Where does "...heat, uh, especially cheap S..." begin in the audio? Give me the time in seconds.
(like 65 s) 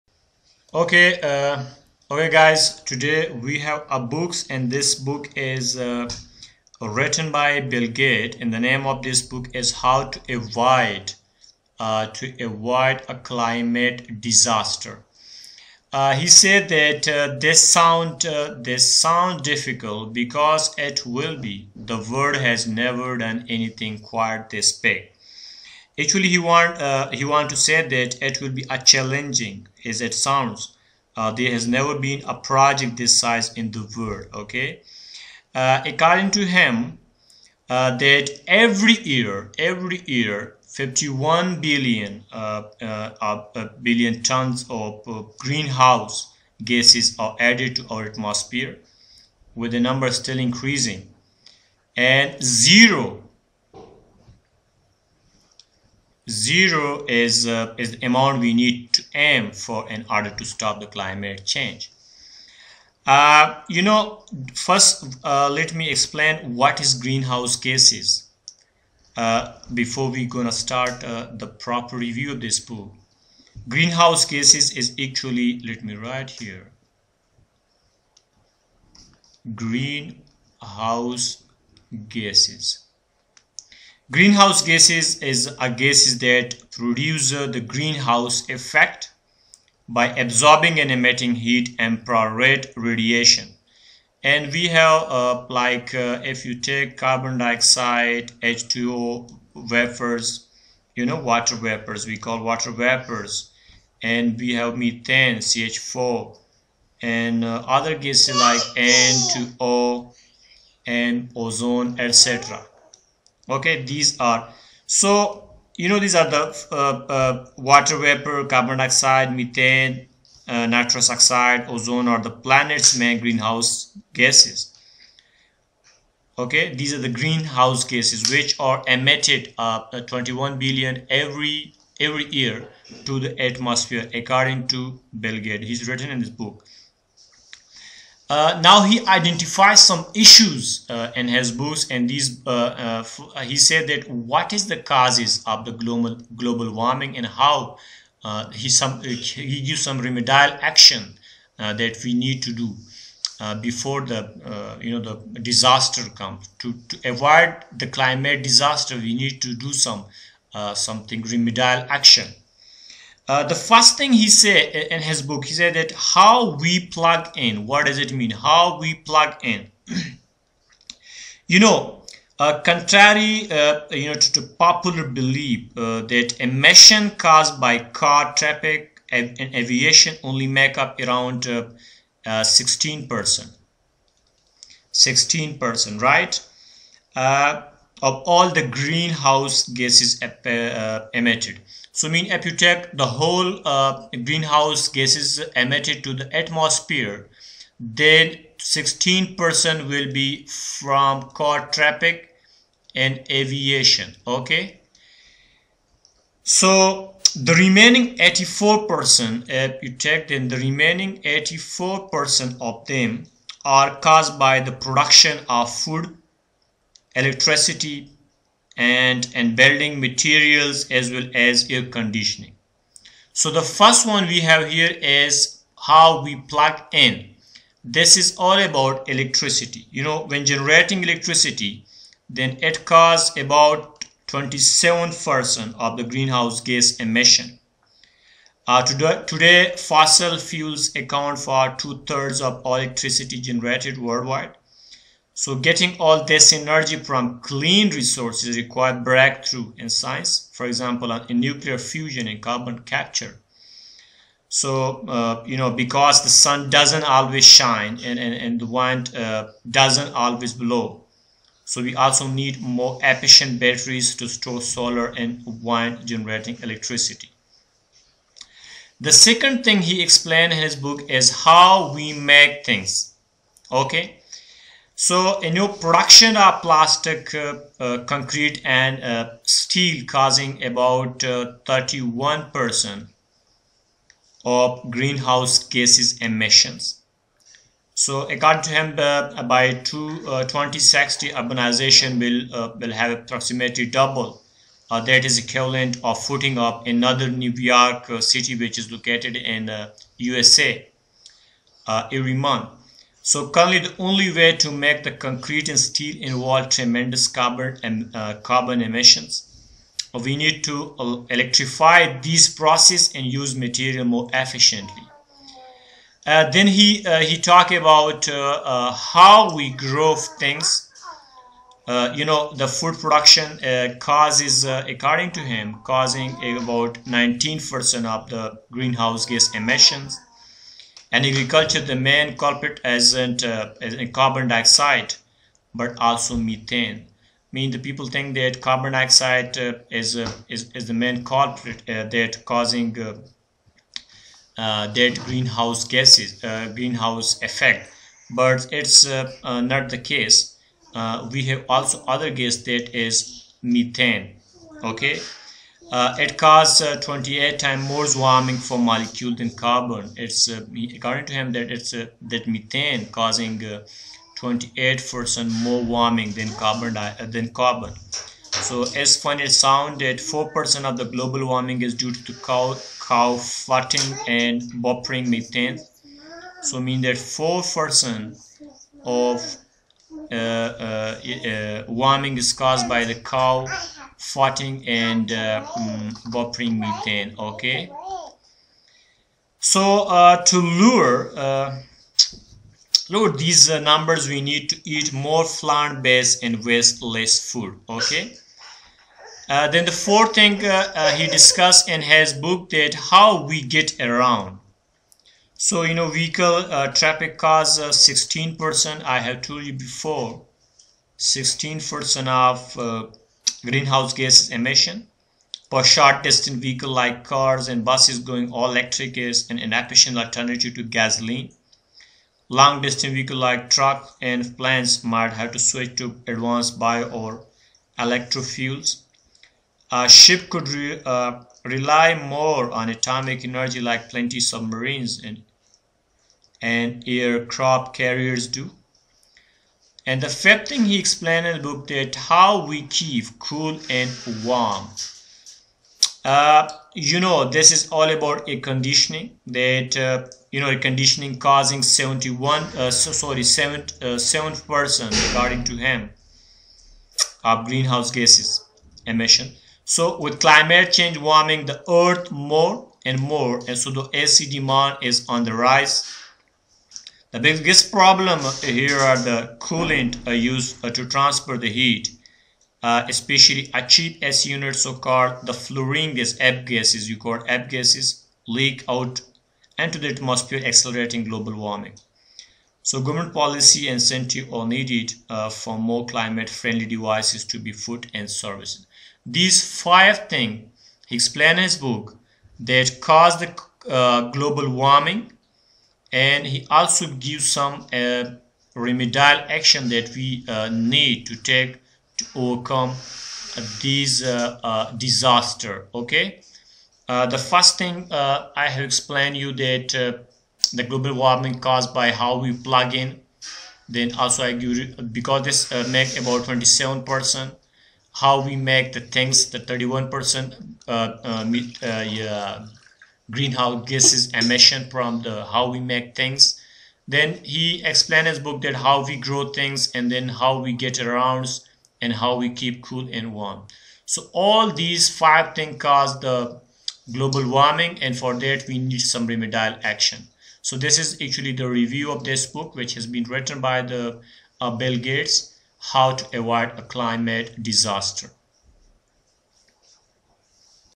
471 s.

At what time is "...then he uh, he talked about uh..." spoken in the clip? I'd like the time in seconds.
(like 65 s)
316 s.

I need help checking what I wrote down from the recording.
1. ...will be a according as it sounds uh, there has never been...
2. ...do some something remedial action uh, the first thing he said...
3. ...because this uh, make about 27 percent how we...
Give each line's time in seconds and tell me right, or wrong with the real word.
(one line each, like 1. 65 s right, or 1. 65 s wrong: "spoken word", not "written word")
1. 28 s wrong: "challenging", not "according"
2. 159 s right
3. 515 s right.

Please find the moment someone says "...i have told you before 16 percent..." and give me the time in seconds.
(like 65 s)
409 s.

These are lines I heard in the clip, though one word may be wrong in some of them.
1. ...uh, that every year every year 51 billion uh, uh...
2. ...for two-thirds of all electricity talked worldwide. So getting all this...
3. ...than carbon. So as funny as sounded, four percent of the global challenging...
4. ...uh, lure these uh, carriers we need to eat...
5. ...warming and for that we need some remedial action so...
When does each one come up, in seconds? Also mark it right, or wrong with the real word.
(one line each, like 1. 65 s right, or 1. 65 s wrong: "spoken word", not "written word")
1. 37 s right
2. 241 s wrong: "generated", not "talked"
3. 367 s wrong: "warming", not "challenging"
4. 391 s wrong: "numbers", not "carriers"
5. 537 s right.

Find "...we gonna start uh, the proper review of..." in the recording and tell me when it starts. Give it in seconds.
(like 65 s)
70 s.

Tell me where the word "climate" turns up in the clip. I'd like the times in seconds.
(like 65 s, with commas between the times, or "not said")
13 s, 60 s, 157 s, 460 s, 486 s, 546 s.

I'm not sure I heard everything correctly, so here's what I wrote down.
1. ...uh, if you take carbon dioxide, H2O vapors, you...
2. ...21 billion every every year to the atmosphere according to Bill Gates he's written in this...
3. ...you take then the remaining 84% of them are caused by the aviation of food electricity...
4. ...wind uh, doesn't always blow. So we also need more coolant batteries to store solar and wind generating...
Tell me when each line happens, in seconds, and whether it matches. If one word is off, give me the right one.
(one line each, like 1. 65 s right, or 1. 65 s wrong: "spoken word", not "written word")
1. 95 s right
2. 130 s right
3. 209 s wrong: "production", not "aviation"
4. 258 s wrong: "efficient", not "coolant".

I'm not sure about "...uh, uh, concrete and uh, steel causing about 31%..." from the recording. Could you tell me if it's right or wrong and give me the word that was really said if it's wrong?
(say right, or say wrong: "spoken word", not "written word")
right.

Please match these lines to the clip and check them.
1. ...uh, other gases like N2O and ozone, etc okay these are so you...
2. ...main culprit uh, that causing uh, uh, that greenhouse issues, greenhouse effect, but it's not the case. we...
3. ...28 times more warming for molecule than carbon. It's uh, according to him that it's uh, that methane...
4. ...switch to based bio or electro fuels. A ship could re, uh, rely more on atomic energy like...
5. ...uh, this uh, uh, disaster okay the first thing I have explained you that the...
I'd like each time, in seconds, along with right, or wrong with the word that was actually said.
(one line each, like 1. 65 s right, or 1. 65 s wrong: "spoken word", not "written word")
1. 107 s right
2. 340 s wrong: "gases", not "issues"
3. 356 s right
4. 425 s wrong: "advanced", not "based"
5. 502 s right.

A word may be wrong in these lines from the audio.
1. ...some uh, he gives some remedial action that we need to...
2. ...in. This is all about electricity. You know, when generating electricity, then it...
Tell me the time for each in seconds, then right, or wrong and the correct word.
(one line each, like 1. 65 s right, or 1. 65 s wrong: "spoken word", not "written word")
1. 148 s right
2. 226 s right.